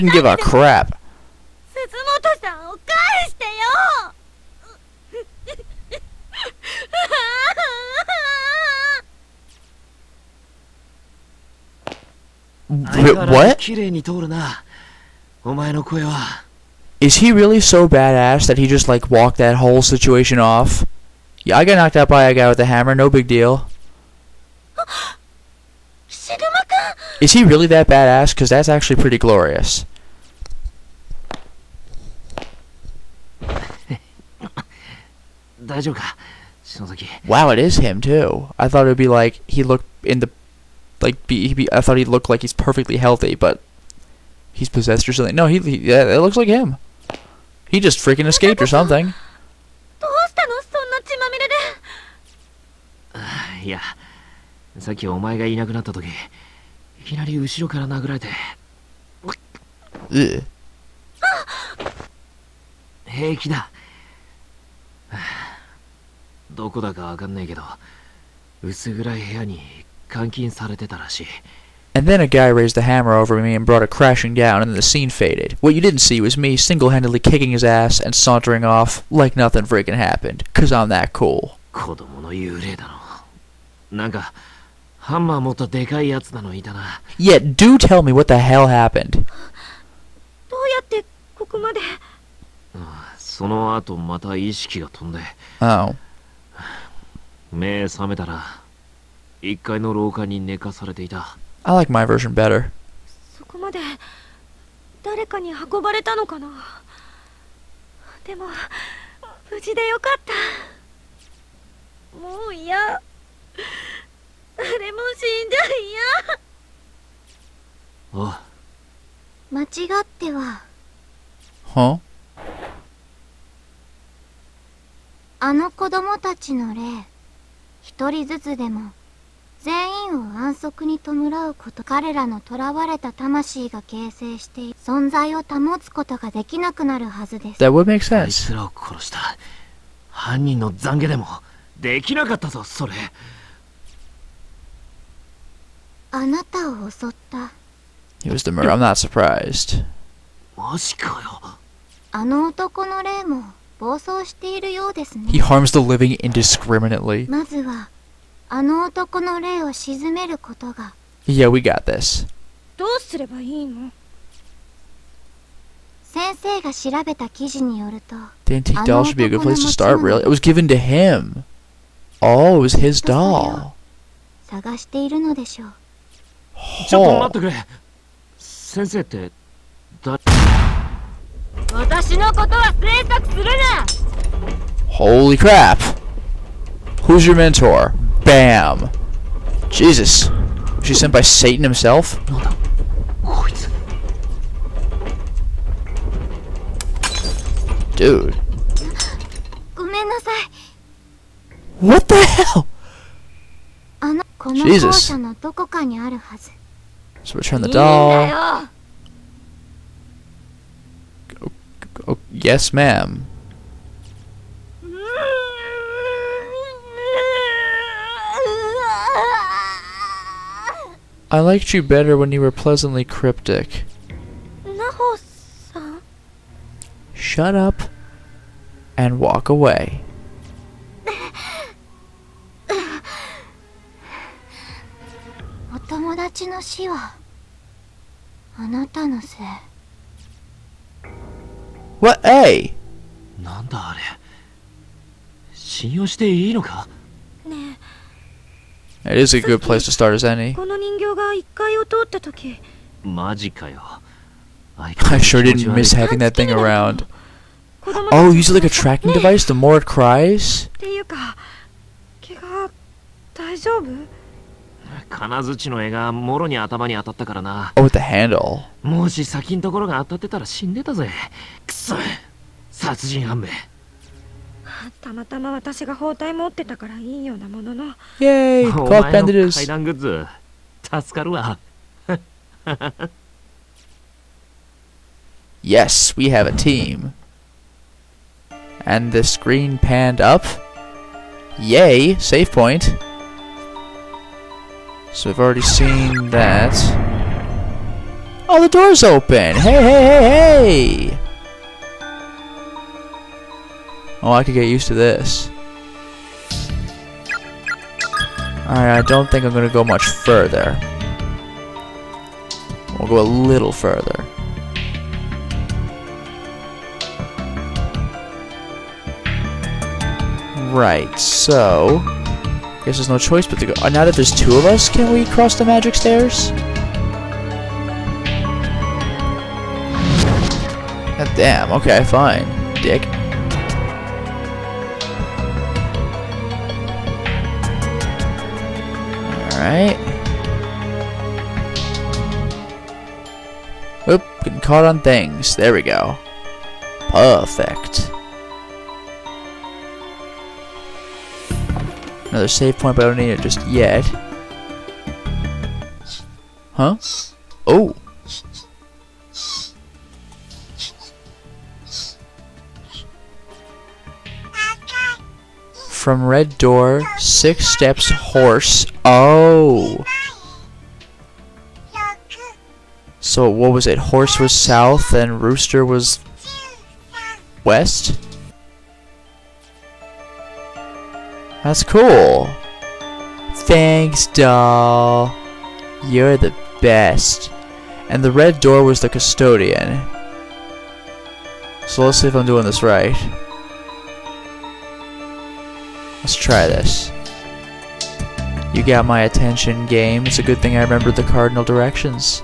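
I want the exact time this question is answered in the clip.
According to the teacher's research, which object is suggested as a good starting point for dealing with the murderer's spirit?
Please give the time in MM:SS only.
02:48.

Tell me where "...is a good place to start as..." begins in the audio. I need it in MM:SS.
04:09.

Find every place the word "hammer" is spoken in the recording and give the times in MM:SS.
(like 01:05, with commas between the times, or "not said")
00:22, 01:12.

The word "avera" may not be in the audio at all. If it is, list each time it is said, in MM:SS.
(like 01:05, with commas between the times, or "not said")
not said.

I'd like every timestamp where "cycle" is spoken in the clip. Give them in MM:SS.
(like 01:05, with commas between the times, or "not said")
not said.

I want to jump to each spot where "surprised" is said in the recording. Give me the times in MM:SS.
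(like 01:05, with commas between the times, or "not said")
02:28.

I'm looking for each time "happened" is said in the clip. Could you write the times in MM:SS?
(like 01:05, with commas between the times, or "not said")
01:19, 01:28.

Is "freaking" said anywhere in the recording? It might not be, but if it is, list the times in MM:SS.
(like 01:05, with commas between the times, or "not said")
00:47, 01:19.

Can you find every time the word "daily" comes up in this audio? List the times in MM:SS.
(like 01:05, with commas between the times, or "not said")
not said.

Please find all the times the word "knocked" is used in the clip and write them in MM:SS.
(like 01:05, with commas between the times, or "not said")
00:21.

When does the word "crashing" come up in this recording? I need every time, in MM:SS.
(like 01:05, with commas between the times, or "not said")
01:13.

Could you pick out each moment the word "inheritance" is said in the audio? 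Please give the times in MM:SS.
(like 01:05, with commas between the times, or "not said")
not said.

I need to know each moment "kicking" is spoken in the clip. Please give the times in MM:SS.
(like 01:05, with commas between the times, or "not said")
01:17.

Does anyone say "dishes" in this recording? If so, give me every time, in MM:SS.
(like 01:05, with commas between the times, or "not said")
not said.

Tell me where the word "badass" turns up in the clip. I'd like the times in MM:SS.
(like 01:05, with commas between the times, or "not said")
00:17, 00:27.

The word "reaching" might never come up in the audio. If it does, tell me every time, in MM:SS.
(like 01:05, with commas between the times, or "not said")
not said.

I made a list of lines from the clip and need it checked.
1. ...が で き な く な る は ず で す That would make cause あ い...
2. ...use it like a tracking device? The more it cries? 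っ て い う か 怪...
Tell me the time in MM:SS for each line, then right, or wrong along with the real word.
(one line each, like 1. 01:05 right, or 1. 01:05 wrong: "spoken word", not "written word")
1. 02:16 wrong: "sense", not "cause"
2. 04:18 right.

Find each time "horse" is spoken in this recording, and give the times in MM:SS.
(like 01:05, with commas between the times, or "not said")
06:08, 06:13.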